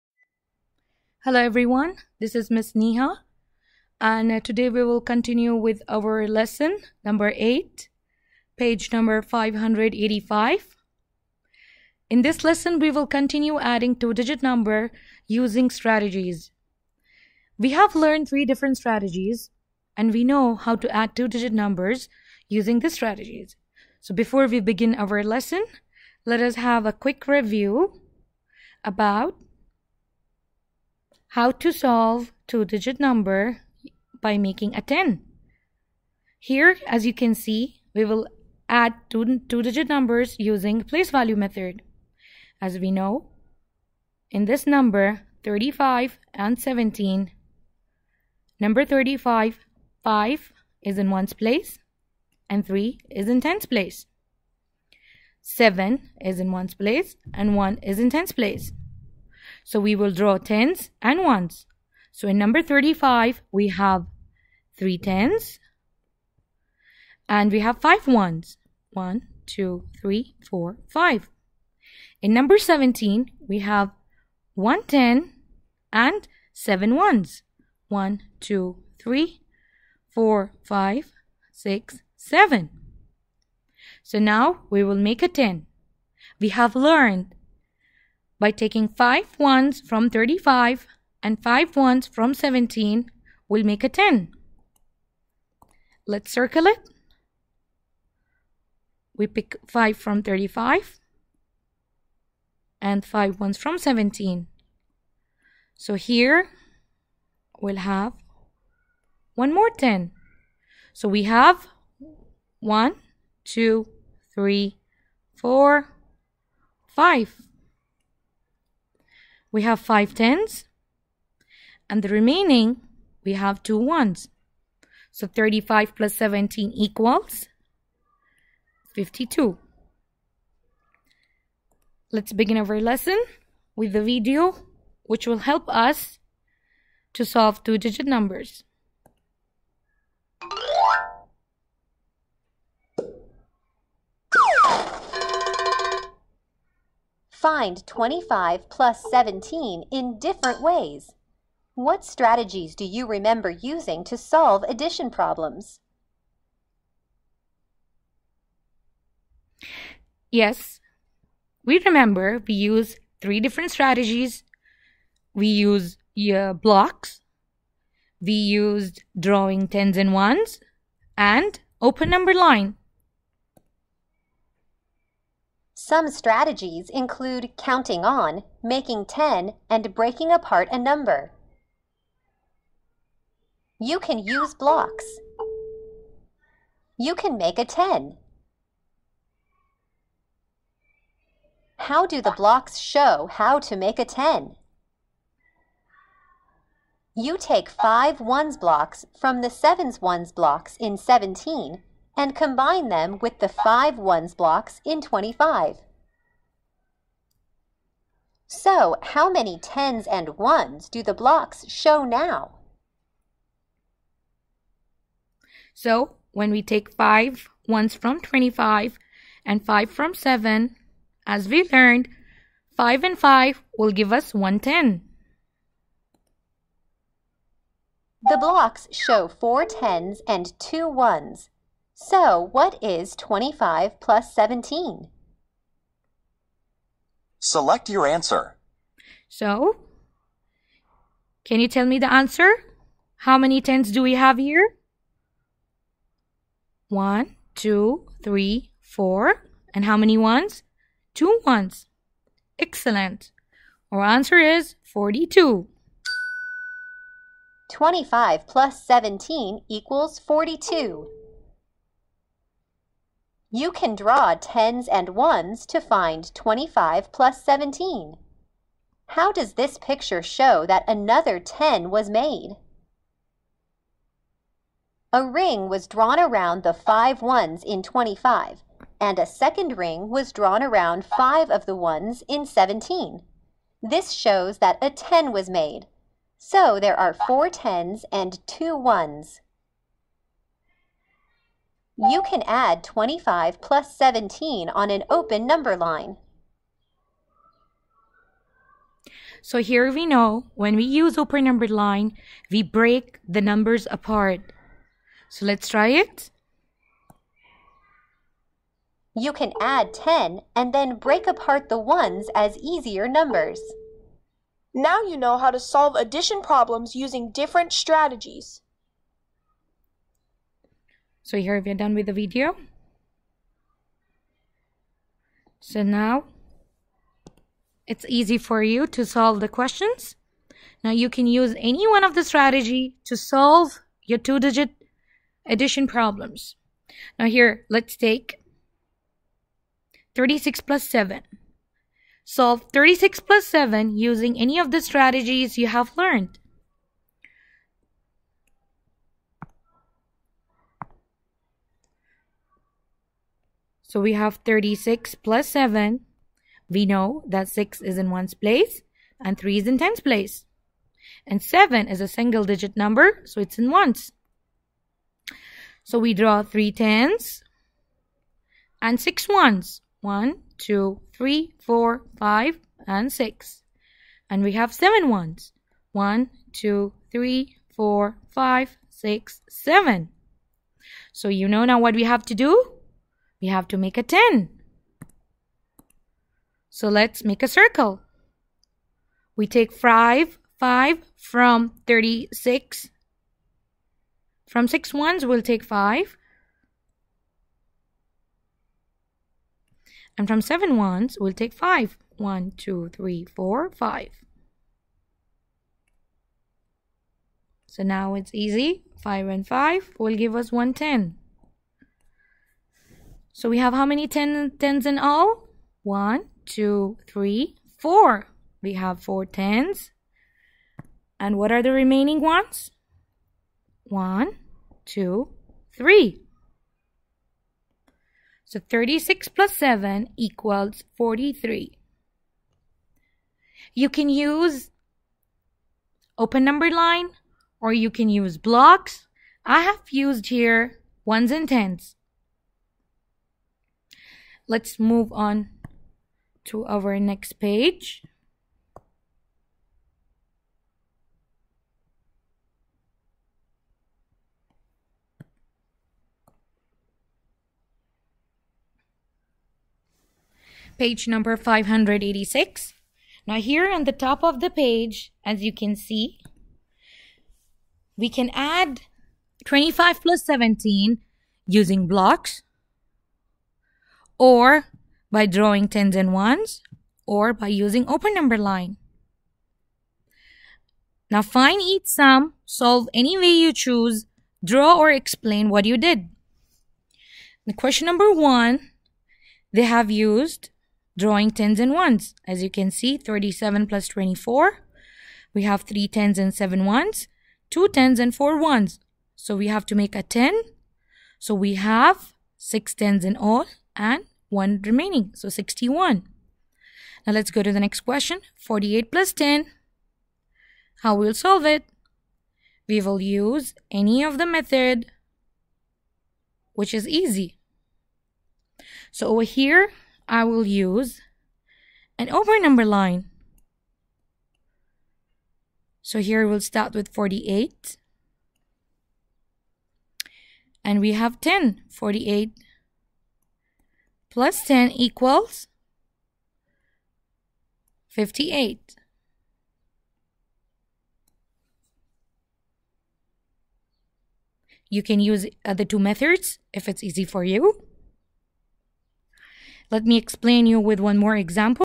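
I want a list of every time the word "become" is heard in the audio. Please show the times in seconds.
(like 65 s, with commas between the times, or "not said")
not said.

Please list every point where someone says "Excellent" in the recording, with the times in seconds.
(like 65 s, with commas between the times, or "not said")
252 s.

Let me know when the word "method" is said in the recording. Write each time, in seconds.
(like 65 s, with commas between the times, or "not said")
41 s, 514 s, 545 s.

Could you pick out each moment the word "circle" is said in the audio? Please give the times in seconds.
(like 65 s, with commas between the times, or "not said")
96 s, 387 s.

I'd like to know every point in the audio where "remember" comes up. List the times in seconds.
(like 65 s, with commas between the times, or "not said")
153 s, 161 s.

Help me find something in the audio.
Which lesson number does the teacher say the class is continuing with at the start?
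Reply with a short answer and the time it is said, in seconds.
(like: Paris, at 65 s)
8, at 6 s.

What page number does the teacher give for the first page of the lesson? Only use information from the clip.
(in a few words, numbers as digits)
585.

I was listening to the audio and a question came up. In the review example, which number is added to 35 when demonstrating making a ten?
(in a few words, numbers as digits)
17.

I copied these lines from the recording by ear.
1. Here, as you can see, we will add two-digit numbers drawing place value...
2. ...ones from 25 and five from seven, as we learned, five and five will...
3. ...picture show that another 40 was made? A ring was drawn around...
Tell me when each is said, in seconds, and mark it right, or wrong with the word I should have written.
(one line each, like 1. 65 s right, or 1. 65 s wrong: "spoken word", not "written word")
1. 36 s wrong: "using", not "drawing"
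2. 217 s right
3. 269 s wrong: "10", not "40".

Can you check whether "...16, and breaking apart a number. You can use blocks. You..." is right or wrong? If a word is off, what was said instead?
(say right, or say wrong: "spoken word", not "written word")
wrong: "10", not "16".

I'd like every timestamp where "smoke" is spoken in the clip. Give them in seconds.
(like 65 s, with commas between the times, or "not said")
not said.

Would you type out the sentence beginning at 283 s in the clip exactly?
This shows that a 10 was made.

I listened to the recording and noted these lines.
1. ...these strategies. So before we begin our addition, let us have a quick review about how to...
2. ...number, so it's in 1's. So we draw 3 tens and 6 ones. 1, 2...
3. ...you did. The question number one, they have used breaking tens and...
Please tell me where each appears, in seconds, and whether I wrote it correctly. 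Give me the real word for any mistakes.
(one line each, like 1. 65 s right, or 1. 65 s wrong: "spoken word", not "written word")
1. 22 s wrong: "lesson", not "addition"
2. 362 s right
3. 485 s wrong: "drawing", not "breaking".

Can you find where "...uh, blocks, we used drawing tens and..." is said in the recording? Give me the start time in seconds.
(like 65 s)
166 s.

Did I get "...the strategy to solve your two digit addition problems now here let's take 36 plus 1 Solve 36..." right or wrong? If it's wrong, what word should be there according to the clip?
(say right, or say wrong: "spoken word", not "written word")
wrong: "7", not "1".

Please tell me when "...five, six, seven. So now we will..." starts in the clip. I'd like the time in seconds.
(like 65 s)
80 s.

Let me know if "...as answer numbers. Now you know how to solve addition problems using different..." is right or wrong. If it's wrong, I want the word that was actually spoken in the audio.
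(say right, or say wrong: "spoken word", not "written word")
wrong: "easier", not "answer".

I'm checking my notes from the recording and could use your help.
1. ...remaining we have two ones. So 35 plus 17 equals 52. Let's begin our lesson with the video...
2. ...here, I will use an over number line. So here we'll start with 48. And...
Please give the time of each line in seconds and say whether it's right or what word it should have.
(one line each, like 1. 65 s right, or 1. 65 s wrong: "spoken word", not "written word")
1. 122 s right
2. 519 s right.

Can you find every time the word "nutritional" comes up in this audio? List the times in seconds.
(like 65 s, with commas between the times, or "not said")
not said.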